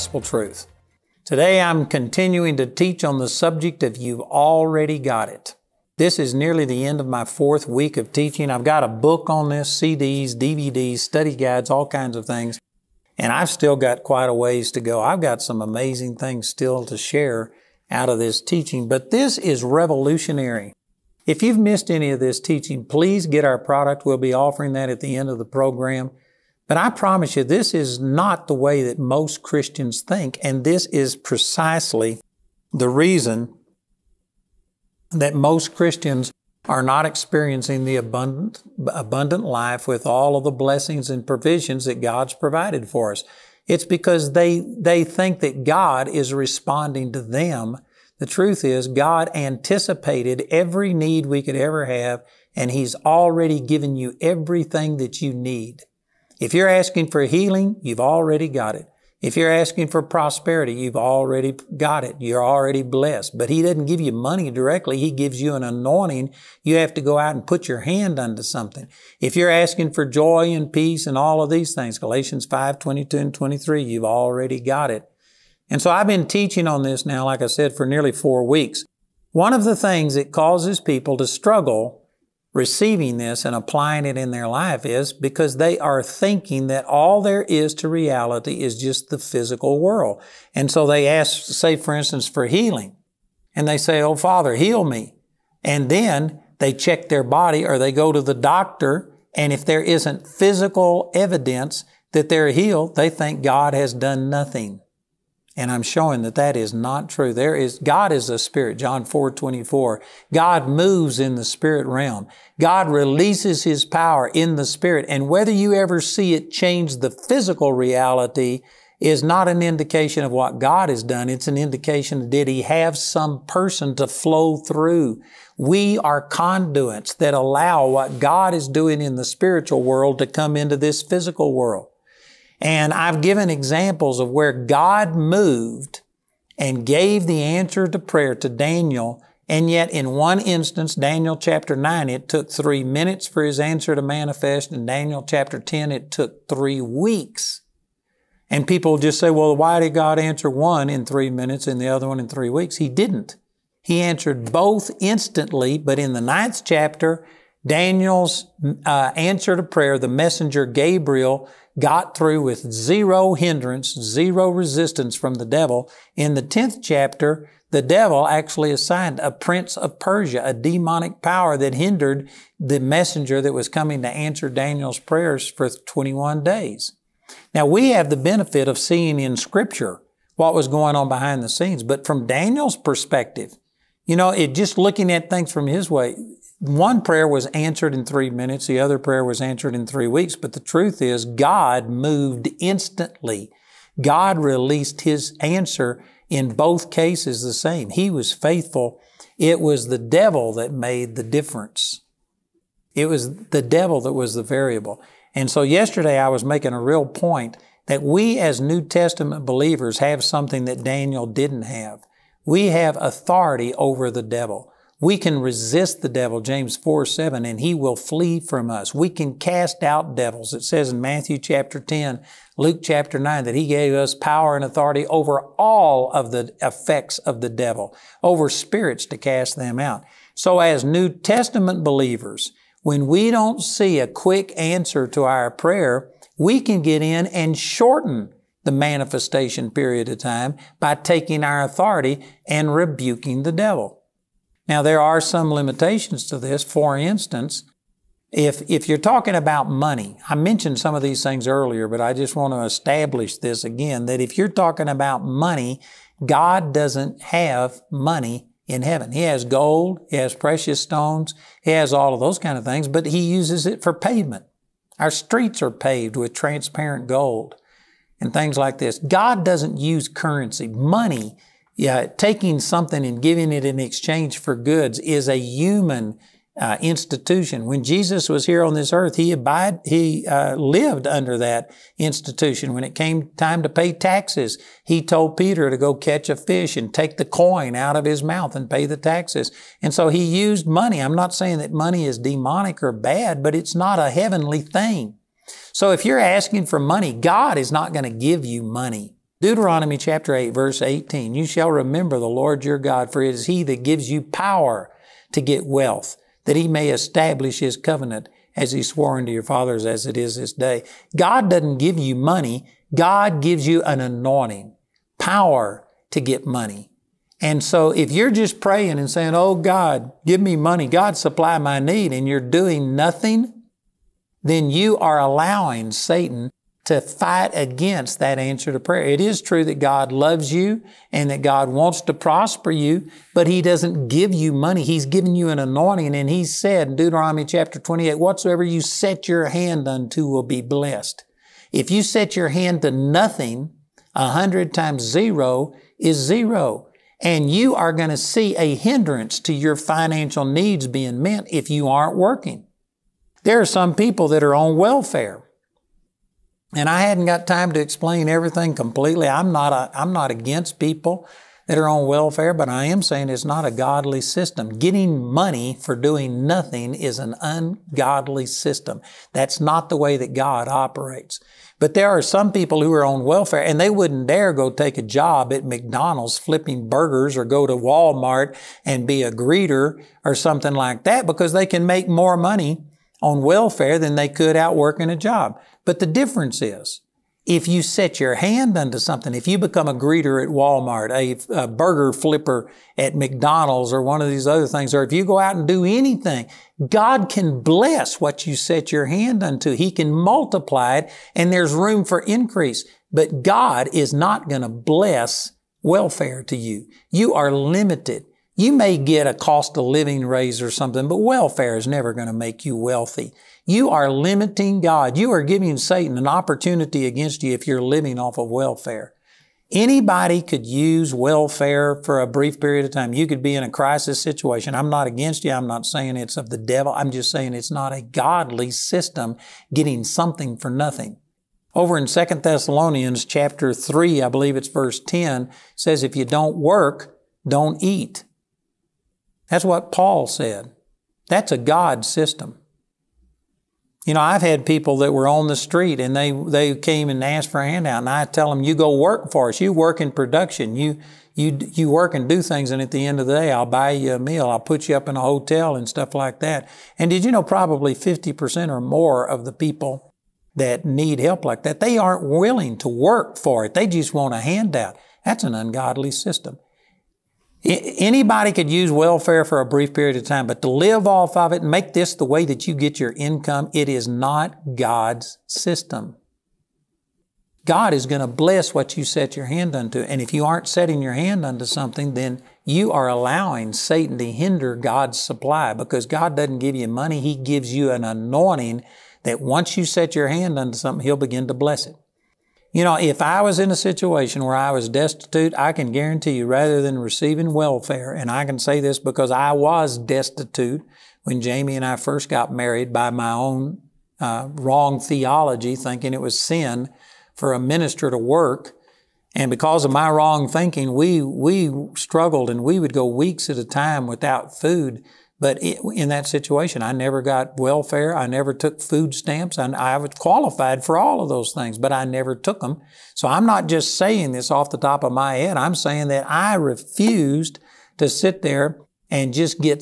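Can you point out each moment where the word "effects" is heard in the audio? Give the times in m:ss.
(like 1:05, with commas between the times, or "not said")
3:46.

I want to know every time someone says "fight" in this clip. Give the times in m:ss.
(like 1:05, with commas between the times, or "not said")
5:26.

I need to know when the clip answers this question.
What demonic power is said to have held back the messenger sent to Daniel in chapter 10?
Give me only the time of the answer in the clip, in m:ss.
2:49.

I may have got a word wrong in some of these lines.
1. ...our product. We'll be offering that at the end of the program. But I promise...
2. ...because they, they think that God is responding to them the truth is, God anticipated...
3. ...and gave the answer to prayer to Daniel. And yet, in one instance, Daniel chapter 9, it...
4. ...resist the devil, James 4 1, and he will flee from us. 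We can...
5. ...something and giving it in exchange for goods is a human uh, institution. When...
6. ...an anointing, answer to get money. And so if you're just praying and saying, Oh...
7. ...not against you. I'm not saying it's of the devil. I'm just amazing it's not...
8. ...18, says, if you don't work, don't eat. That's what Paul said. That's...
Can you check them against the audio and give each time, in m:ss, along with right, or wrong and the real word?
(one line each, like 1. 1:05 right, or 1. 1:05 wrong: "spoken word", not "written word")
1. 0:23 right
2. 0:43 right
3. 2:16 right
4. 3:35 wrong: "7", not "1"
5. 4:32 right
6. 5:13 wrong: "power", not "answer"
7. 7:04 wrong: "saying", not "amazing"
8. 7:14 wrong: "10", not "18".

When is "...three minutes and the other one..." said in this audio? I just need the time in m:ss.
2:31.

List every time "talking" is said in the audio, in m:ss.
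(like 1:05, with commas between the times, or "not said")
4:08, 4:14.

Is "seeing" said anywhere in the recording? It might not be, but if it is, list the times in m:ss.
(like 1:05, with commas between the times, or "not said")
2:58.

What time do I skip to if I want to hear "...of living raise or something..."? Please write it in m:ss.
6:49.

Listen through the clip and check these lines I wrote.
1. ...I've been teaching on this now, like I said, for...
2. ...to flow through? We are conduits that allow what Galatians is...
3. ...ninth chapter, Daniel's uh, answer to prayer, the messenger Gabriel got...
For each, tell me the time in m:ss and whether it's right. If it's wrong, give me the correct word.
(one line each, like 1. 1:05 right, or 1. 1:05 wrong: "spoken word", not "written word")
1. 1:15 right
2. 2:03 wrong: "God", not "Galatians"
3. 2:36 right.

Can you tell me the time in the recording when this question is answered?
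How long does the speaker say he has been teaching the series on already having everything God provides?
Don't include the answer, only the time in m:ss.
0:07.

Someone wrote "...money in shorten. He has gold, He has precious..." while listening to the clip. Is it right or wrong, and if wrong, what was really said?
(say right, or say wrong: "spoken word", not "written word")
wrong: "heaven", not "shorten".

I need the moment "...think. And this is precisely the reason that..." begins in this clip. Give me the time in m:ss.
0:30.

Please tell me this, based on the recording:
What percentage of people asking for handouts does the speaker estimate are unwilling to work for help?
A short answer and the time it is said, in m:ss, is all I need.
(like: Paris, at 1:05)
50%, at 7:37.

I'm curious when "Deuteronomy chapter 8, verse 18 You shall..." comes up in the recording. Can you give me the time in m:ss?
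4:59.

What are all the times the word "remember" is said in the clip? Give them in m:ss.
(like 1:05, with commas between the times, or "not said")
5:01.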